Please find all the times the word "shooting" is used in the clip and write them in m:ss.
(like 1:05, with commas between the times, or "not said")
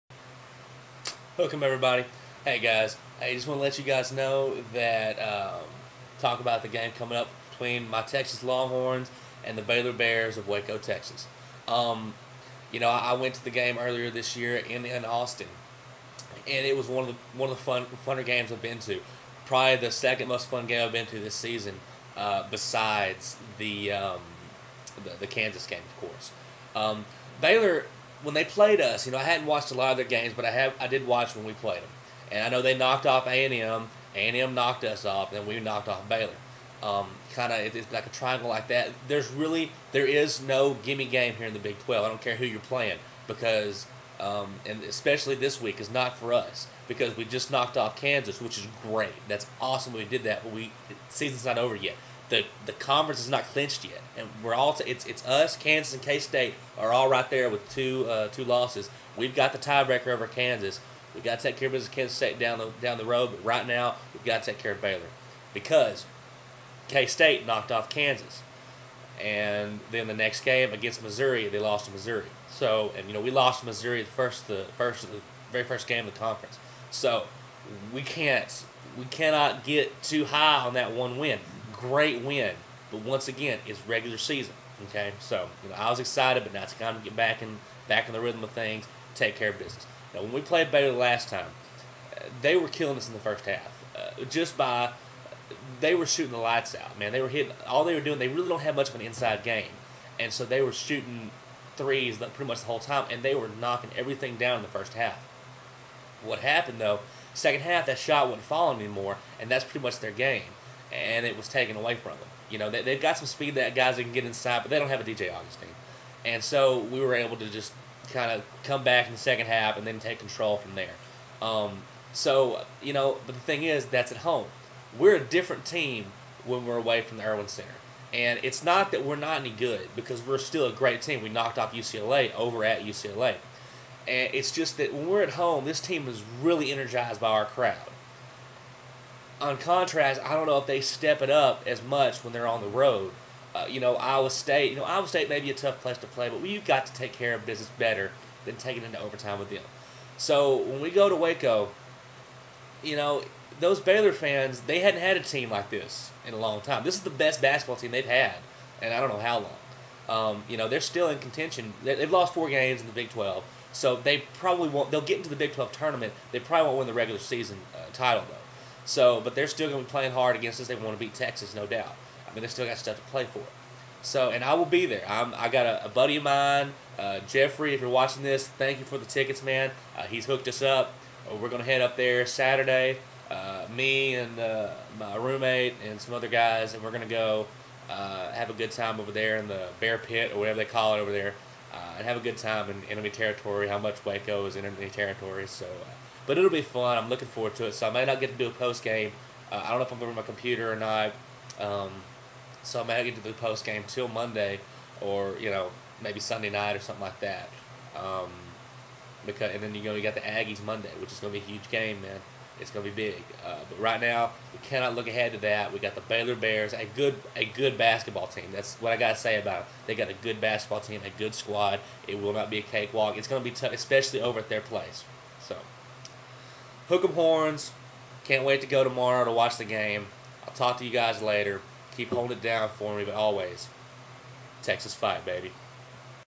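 1:36, 1:40.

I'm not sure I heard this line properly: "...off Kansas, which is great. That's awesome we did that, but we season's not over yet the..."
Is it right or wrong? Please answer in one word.
right.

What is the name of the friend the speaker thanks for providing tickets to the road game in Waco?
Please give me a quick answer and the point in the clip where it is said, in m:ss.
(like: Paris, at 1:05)
Jeffrey, at 2:57.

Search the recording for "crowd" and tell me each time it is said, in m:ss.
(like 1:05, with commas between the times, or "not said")
2:17.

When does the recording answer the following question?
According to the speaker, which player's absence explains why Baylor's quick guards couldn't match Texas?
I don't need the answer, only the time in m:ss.
1:55.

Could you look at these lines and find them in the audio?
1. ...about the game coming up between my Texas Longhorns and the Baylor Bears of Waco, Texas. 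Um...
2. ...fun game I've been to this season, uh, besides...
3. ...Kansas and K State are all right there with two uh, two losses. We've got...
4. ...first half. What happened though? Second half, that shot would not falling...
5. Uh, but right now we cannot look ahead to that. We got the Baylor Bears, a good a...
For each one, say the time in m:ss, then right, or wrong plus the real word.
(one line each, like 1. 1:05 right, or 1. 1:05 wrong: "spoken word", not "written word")
1. 0:06 right
2. 0:20 right
3. 0:55 right
4. 1:44 right
5. 3:33 right.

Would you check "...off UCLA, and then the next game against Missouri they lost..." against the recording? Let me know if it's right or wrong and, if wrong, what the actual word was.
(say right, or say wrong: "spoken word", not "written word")
wrong: "Kansas", not "UCLA".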